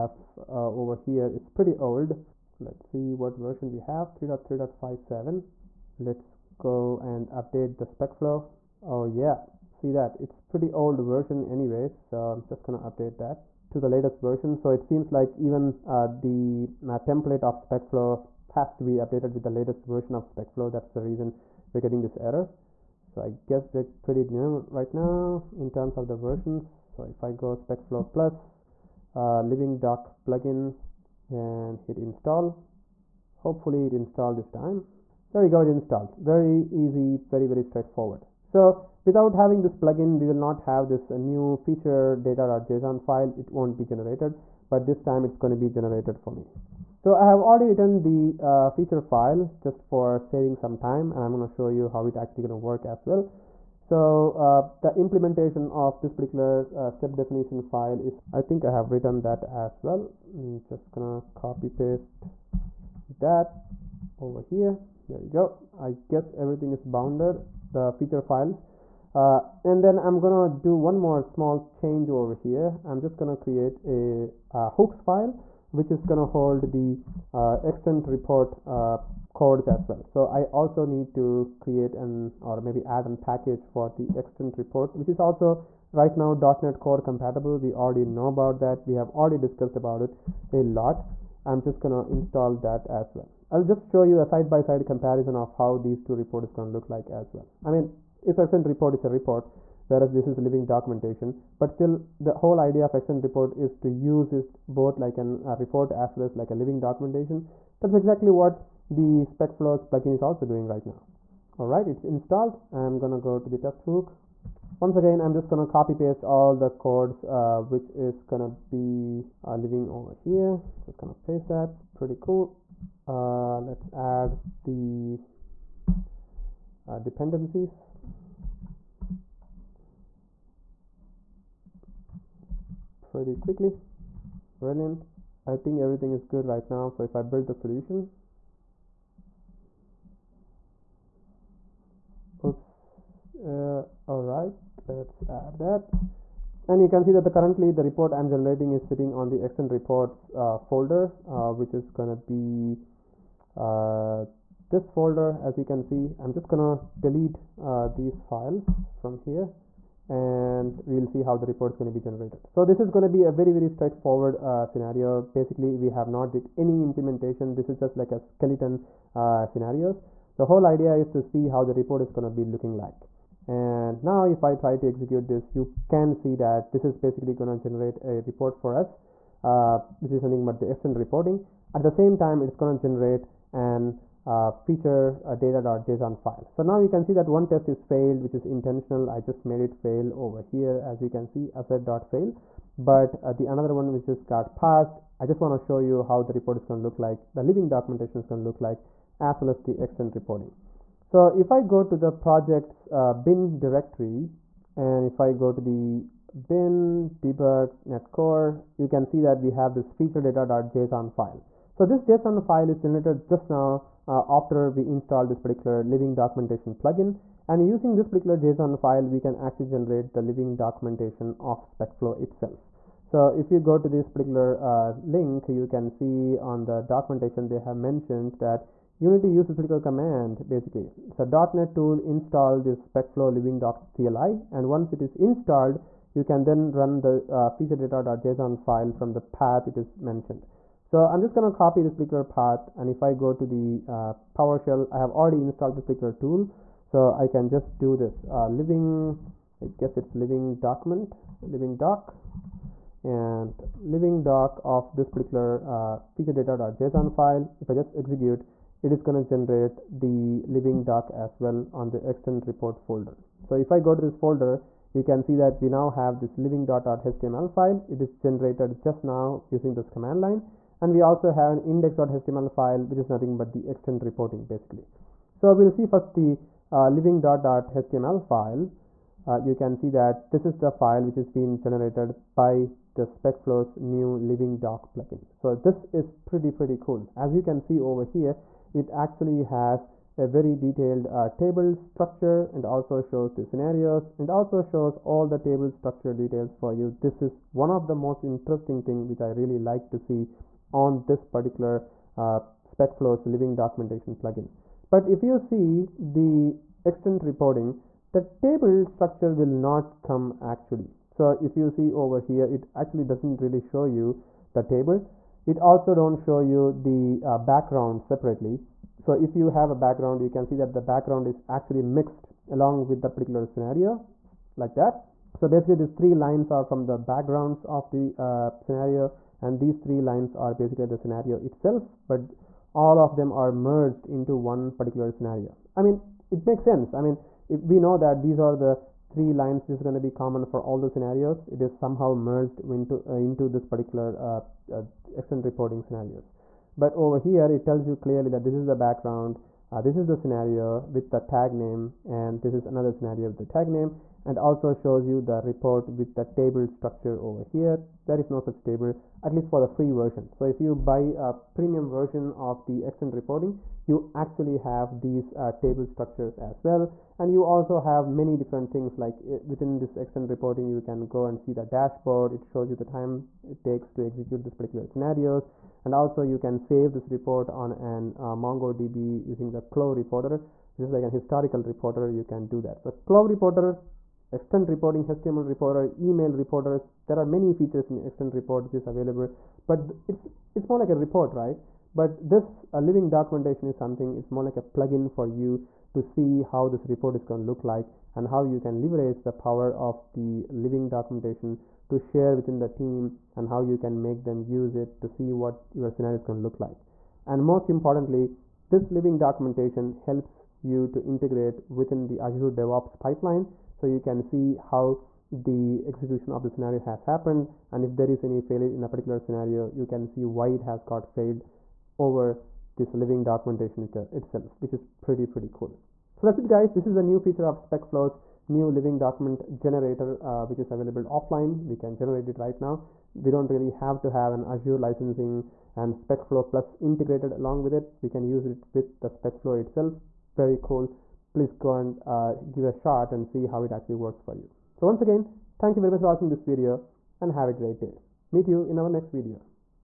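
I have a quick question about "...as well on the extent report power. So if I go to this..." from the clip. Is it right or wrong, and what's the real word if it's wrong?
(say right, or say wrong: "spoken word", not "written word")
wrong: "folder", not "power".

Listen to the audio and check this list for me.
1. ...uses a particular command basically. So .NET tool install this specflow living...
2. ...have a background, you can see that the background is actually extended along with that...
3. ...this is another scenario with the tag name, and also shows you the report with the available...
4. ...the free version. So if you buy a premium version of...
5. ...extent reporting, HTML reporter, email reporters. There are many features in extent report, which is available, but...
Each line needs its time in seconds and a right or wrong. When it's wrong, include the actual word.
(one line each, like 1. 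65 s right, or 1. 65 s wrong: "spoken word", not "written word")
1. 229 s right
2. 319 s wrong: "mixed", not "extended"
3. 352 s wrong: "table", not "available"
4. 359 s right
5. 384 s right.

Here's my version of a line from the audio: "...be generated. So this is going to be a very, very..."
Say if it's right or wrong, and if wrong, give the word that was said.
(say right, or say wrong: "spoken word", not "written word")
right.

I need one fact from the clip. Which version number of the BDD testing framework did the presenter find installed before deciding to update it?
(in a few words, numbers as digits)
3.3.57.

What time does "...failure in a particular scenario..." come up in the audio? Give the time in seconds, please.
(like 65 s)
418 s.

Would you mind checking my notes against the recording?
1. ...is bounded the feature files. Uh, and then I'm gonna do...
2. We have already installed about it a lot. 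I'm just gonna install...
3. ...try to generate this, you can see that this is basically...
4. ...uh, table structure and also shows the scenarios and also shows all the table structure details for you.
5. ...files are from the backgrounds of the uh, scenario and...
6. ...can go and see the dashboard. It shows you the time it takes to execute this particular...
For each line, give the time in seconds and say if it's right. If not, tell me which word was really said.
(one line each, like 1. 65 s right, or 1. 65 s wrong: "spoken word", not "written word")
1. 66 s right
2. 88 s wrong: "discussed", not "installed"
3. 174 s wrong: "execute", not "generate"
4. 291 s right
5. 326 s wrong: "lines", not "files"
6. 370 s right.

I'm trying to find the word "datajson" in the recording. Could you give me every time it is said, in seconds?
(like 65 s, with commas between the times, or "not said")
42 s, 185 s, 210 s, 237 s, 256 s.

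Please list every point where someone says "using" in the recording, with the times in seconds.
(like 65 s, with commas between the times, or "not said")
217 s, 269 s, 379 s.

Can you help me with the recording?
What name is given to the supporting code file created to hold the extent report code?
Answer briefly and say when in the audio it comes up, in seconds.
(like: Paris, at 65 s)
hooks file, at 74 s.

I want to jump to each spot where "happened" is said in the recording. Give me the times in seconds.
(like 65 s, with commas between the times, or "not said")
417 s.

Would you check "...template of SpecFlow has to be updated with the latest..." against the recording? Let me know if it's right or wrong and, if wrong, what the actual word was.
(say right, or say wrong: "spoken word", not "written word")
right.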